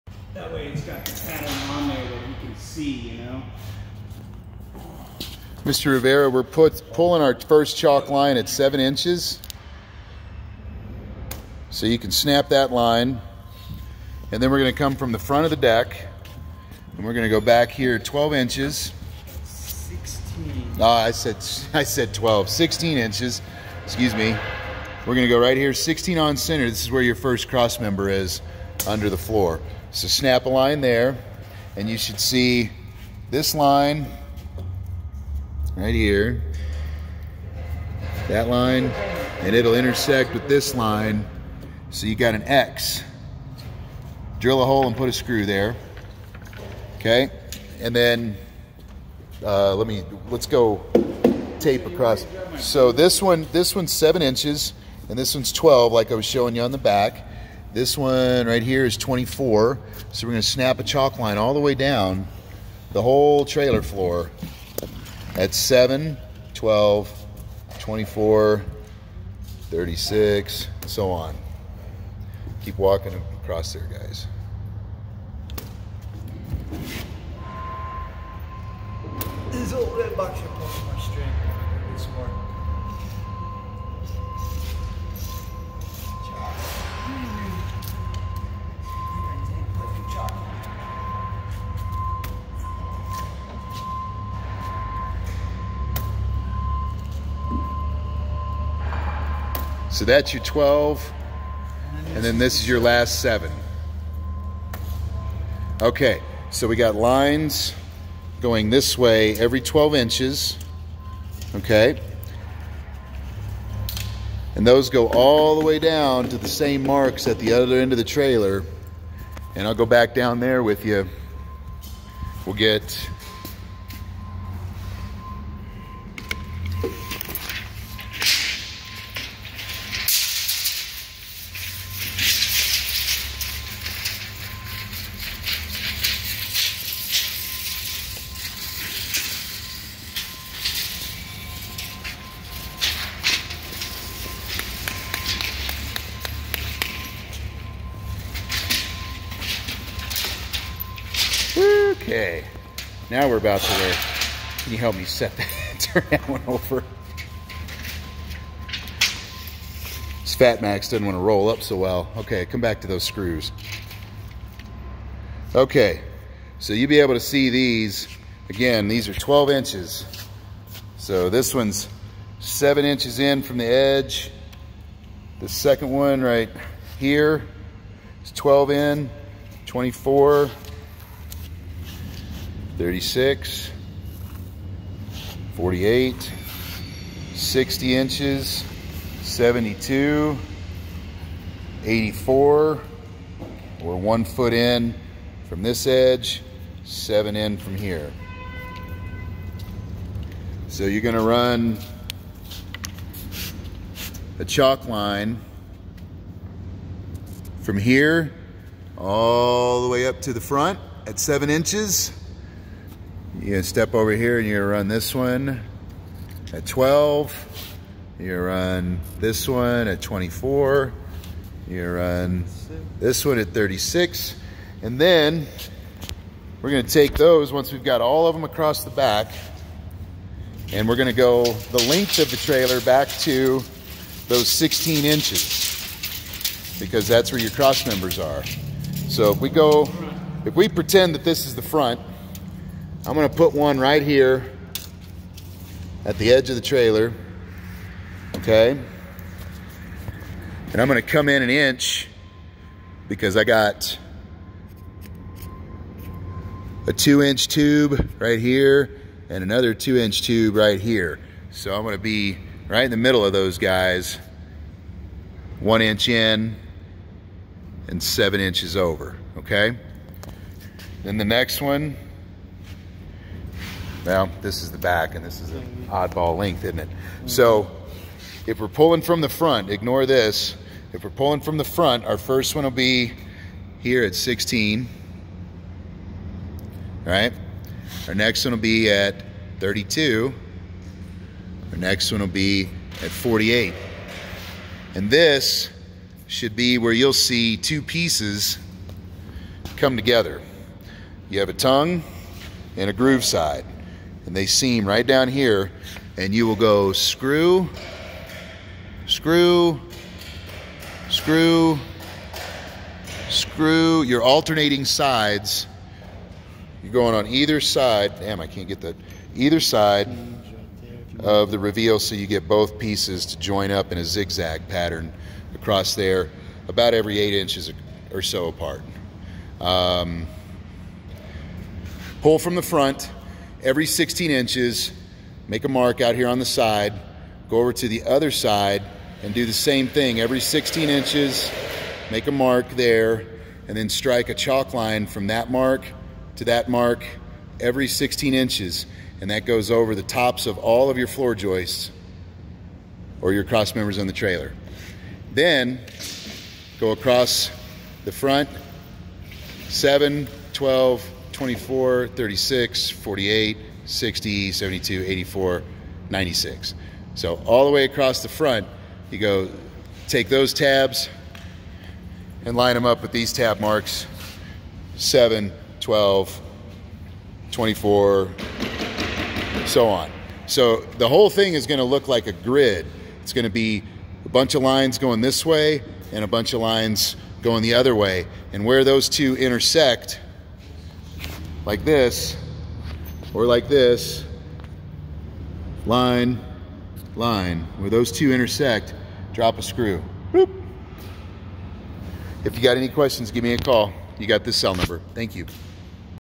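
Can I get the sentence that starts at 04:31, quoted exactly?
Then the next one, well, this is the back and this is an oddball length, isn't it?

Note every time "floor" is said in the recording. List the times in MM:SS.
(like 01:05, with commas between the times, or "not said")
00:29, 01:03, 05:51.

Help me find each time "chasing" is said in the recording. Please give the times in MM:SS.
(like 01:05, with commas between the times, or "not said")
not said.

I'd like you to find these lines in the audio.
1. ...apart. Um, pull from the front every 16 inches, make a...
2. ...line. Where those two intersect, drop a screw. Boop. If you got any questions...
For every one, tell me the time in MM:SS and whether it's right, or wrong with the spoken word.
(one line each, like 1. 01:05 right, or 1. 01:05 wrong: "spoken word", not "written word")
1. 05:28 right
2. 06:37 right.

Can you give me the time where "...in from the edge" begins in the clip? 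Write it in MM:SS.
02:53.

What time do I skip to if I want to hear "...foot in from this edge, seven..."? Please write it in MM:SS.
03:14.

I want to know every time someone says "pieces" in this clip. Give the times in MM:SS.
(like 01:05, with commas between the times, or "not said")
04:57, 05:22.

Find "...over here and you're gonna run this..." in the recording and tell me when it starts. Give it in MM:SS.
03:33.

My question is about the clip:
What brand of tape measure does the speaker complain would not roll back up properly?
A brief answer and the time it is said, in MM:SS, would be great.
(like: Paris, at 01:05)
Fat Max, at 02:40.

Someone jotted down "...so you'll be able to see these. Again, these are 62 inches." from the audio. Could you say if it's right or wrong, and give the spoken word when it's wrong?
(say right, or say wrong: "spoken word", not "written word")
wrong: "12", not "62".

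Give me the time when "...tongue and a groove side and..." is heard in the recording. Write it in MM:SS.
05:01.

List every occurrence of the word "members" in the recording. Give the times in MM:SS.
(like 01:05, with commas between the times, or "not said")
00:27, 03:57, 05:53.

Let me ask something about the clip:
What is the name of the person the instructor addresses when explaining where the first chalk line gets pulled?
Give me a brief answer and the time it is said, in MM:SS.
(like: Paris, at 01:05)
Mr. Rivera, at 00:05.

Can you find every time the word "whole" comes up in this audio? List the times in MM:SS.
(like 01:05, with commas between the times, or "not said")
01:03, 06:21.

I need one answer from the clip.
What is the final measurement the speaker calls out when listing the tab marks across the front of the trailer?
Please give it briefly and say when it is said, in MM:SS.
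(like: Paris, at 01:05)
96, at 06:06.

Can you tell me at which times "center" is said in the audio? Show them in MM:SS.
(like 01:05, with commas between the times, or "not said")
00:26.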